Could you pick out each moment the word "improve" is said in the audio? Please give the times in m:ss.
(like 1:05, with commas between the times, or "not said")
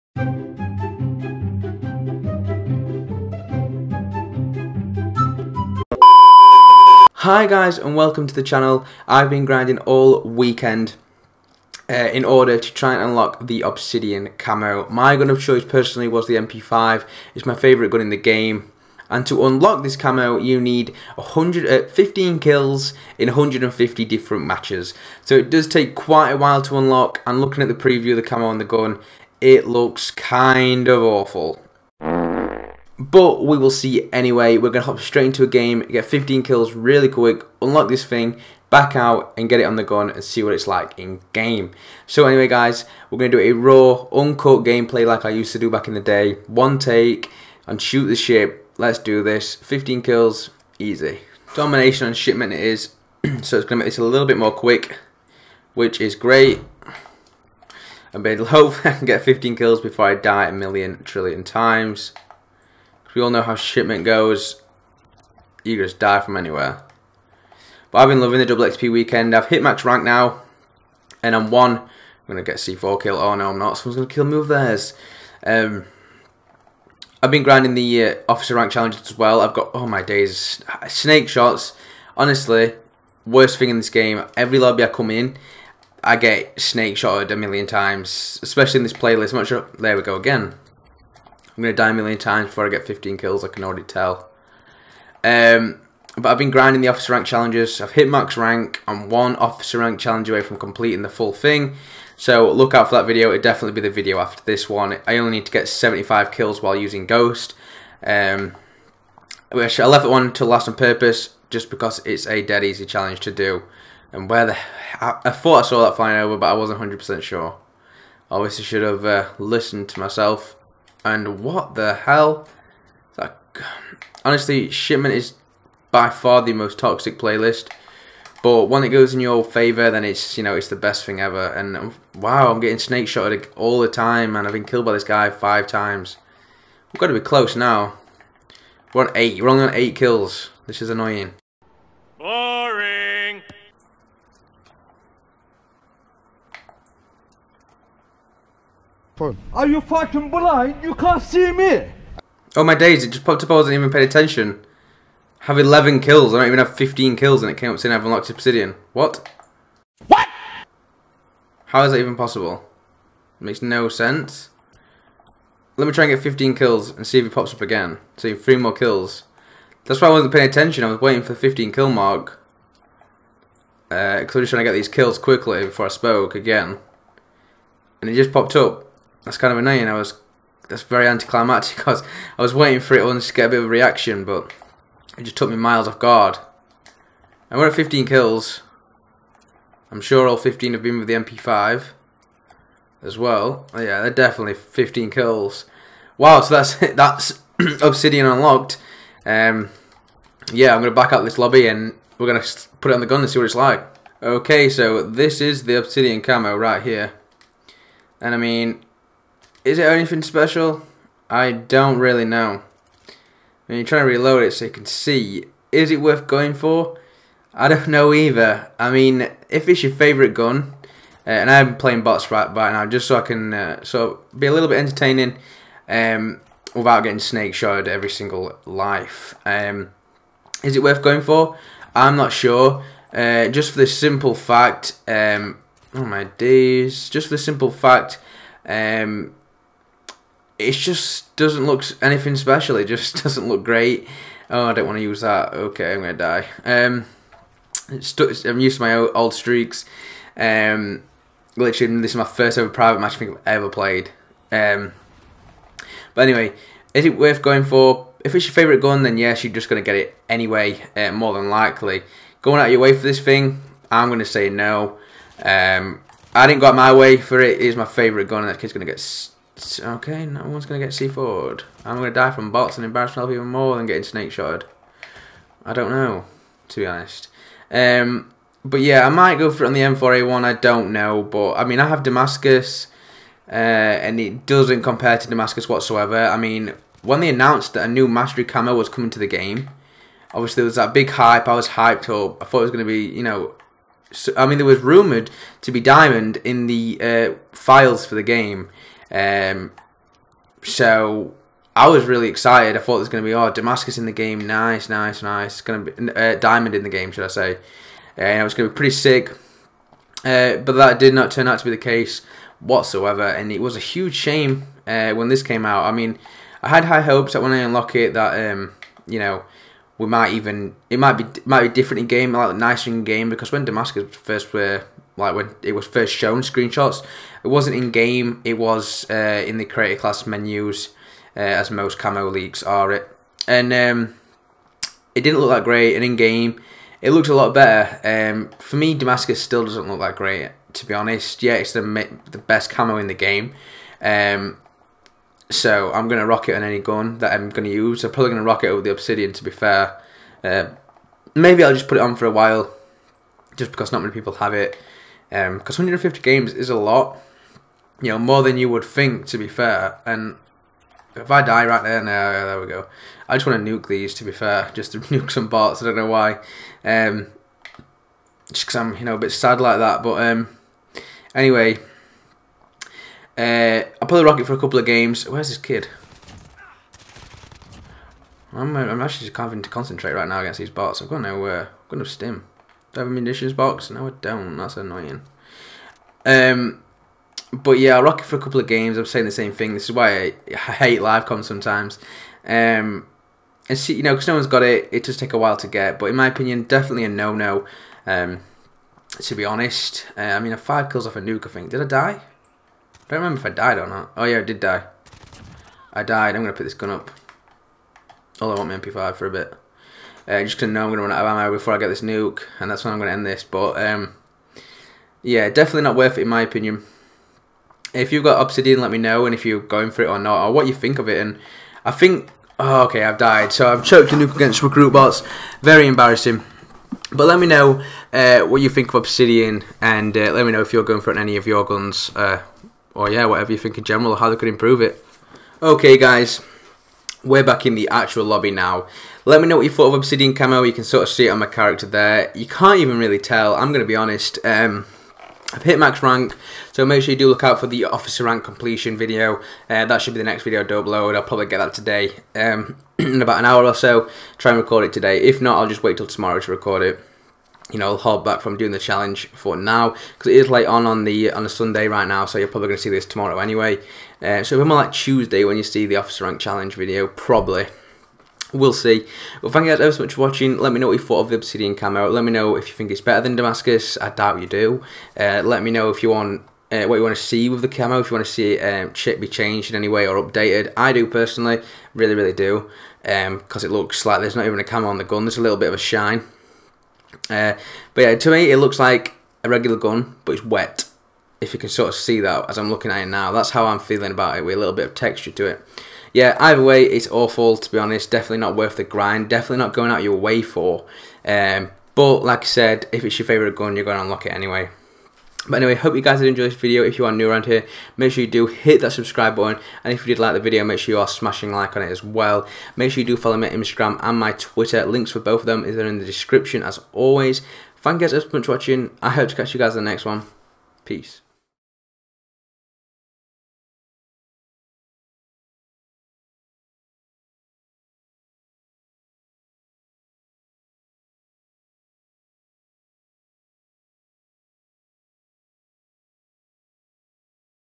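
7:14.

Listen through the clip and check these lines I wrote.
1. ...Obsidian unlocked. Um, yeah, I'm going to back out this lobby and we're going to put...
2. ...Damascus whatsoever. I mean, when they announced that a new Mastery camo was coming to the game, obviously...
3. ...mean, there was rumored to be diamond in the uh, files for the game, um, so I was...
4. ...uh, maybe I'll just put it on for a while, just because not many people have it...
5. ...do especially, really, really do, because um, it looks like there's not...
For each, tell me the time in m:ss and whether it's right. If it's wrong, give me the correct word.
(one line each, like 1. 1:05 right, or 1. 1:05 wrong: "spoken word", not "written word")
1. 3:17 right
2. 4:45 right
3. 4:54 right
4. 5:50 right
5. 8:00 wrong: "personally", not "especially".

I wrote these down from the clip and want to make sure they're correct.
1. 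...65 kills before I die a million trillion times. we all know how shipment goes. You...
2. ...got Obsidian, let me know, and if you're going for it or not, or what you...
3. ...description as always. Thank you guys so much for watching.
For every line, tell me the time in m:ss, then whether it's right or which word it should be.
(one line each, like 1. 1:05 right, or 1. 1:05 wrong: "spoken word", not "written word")
1. 0:59 wrong: "15", not "65"
2. 6:58 right
3. 8:36 right.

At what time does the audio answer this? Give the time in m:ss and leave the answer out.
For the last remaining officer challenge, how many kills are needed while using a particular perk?
1:45.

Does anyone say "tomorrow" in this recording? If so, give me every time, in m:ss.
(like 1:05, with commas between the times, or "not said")
7:36, 7:43.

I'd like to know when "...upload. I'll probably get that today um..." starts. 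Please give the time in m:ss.
7:30.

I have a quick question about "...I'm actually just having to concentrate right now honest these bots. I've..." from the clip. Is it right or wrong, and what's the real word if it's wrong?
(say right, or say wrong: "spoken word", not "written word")
wrong: "against", not "honest".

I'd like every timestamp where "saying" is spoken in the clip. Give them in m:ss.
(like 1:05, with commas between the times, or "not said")
2:37, 6:29.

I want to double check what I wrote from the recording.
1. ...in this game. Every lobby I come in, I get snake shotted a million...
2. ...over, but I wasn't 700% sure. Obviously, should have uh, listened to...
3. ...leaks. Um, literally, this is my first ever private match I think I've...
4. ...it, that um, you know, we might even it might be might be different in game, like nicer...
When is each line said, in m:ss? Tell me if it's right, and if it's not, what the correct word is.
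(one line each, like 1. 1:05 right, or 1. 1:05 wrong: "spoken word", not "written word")
1. 1:23 right
2. 1:56 wrong: "100", not "700"
3. 4:09 wrong: "streaks", not "leaks"
4. 5:17 right.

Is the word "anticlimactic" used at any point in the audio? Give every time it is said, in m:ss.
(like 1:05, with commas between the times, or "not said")
3:01.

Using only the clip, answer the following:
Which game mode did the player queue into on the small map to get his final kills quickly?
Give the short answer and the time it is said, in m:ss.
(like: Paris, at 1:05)
Domination, at 0:51.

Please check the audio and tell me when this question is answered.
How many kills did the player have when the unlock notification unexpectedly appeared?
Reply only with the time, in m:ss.
2:35.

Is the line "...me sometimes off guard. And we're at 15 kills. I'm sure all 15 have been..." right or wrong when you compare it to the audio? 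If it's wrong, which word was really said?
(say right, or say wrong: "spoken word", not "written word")
wrong: "miles", not "sometimes".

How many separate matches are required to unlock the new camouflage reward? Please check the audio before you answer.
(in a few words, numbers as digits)
150.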